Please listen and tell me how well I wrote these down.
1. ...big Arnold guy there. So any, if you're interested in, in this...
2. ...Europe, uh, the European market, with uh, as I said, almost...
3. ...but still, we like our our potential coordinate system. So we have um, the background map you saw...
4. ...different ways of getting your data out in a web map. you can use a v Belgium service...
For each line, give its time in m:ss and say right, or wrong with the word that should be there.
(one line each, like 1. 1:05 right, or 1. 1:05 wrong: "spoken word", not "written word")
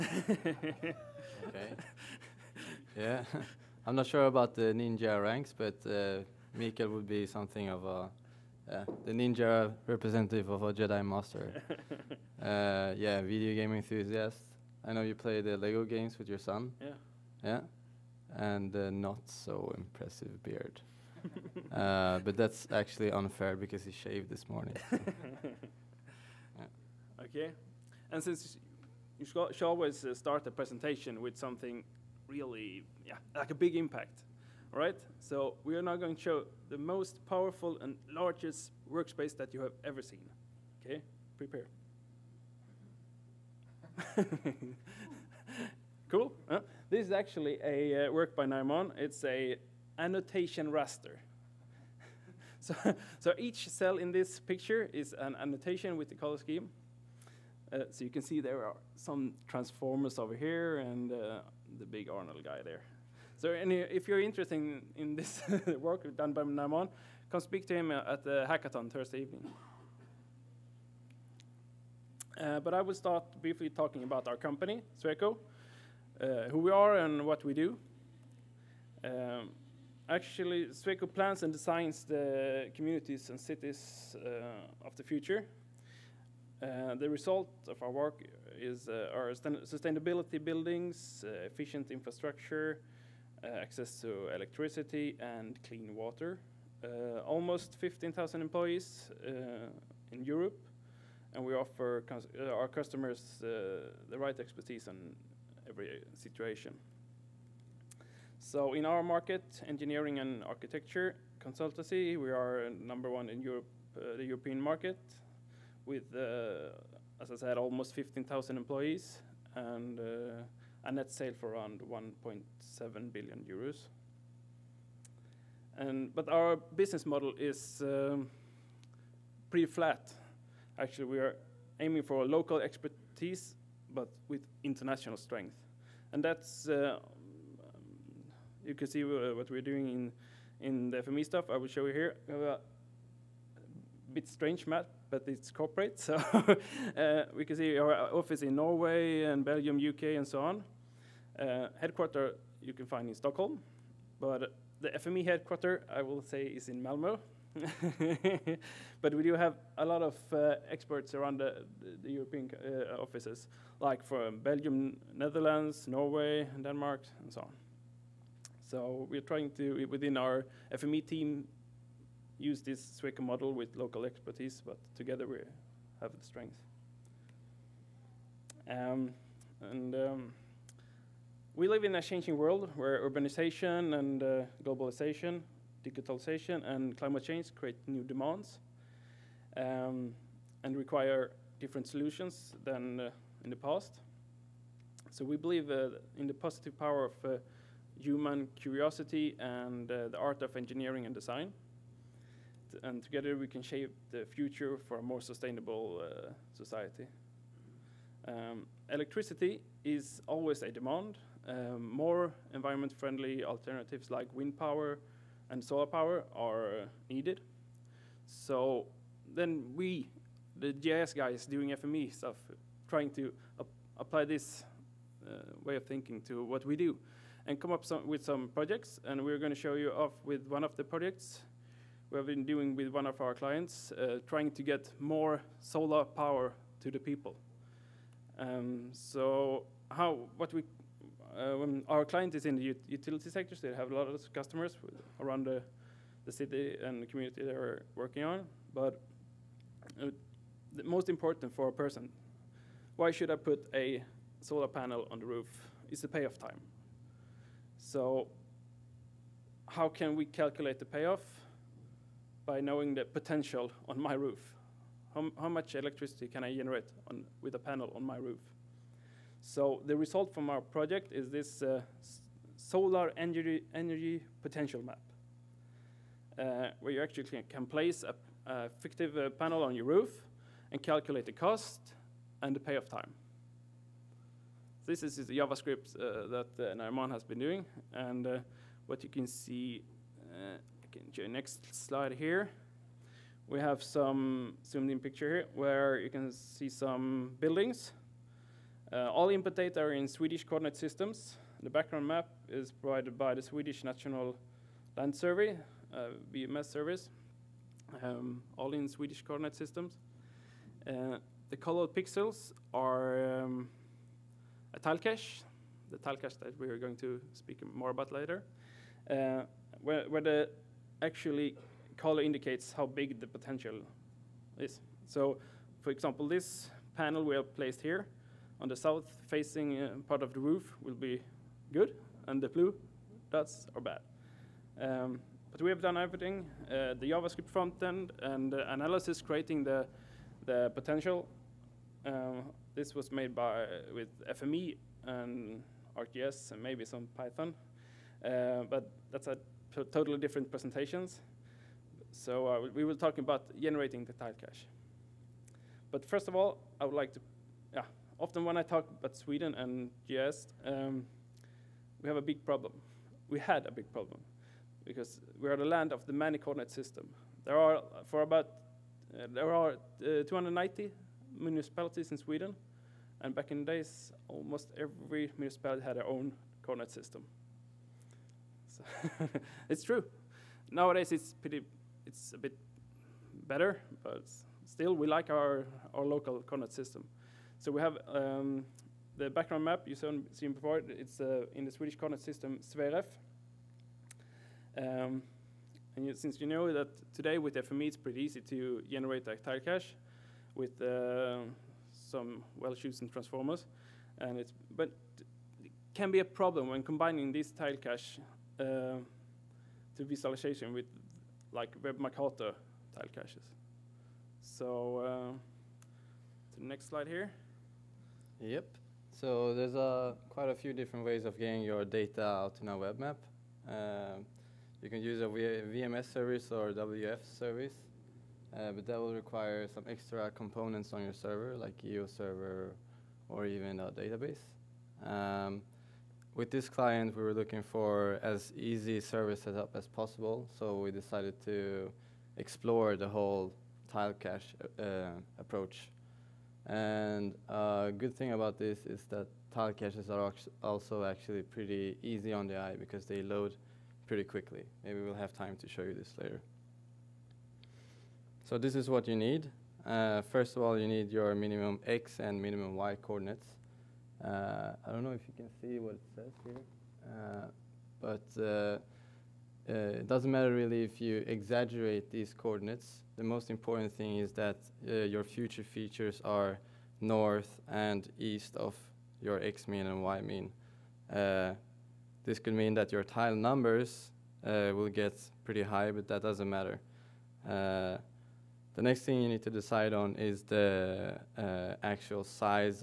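1. 1:01 right
2. 1:53 right
3. 6:24 wrong: "local", not "potential"
4. 7:00 wrong: "VMS", not "Belgium".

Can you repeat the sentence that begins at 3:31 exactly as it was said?
Um, more environment friendly alternatives like wind power and solar power are needed.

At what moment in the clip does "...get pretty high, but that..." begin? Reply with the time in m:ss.
8:04.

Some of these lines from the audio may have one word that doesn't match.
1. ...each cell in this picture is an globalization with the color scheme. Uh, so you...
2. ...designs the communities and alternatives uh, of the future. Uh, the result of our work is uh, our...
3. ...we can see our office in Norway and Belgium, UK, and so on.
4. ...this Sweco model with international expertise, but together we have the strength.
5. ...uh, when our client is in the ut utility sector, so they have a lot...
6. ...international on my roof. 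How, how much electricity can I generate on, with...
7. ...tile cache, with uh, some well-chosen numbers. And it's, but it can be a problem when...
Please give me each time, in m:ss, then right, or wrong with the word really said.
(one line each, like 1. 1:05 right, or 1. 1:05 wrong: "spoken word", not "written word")
1. 0:53 wrong: "annotation", not "globalization"
2. 1:21 wrong: "cities", not "alternatives"
3. 2:27 right
4. 2:52 wrong: "local", not "international"
5. 4:01 right
6. 4:23 wrong: "potential", not "international"
7. 6:39 wrong: "transformers", not "numbers".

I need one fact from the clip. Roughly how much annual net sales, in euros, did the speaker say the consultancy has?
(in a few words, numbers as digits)
1.7 billion euros.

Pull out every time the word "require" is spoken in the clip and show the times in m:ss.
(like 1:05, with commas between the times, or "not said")
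3:10, 7:09.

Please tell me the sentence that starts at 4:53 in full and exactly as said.
We have some zoomed in picture here where you can see some buildings.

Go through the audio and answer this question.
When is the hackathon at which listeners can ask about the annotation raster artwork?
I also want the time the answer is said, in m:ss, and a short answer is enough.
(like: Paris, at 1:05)
Thursday evening, at 1:08.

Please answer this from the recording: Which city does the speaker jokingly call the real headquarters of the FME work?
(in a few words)
Malmo.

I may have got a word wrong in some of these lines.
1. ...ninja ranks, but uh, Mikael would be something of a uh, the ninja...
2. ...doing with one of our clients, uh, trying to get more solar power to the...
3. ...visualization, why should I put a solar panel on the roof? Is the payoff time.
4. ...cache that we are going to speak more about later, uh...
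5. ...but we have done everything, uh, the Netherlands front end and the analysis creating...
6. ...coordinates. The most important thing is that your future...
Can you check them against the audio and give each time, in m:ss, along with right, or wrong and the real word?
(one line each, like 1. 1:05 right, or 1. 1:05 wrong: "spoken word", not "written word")
1. 0:04 right
2. 3:52 right
3. 4:11 wrong: "person", not "visualization"
4. 5:16 right
5. 5:35 wrong: "JavaScript", not "Netherlands"
6. 7:52 right.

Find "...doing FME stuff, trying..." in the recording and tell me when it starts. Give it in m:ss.
3:41.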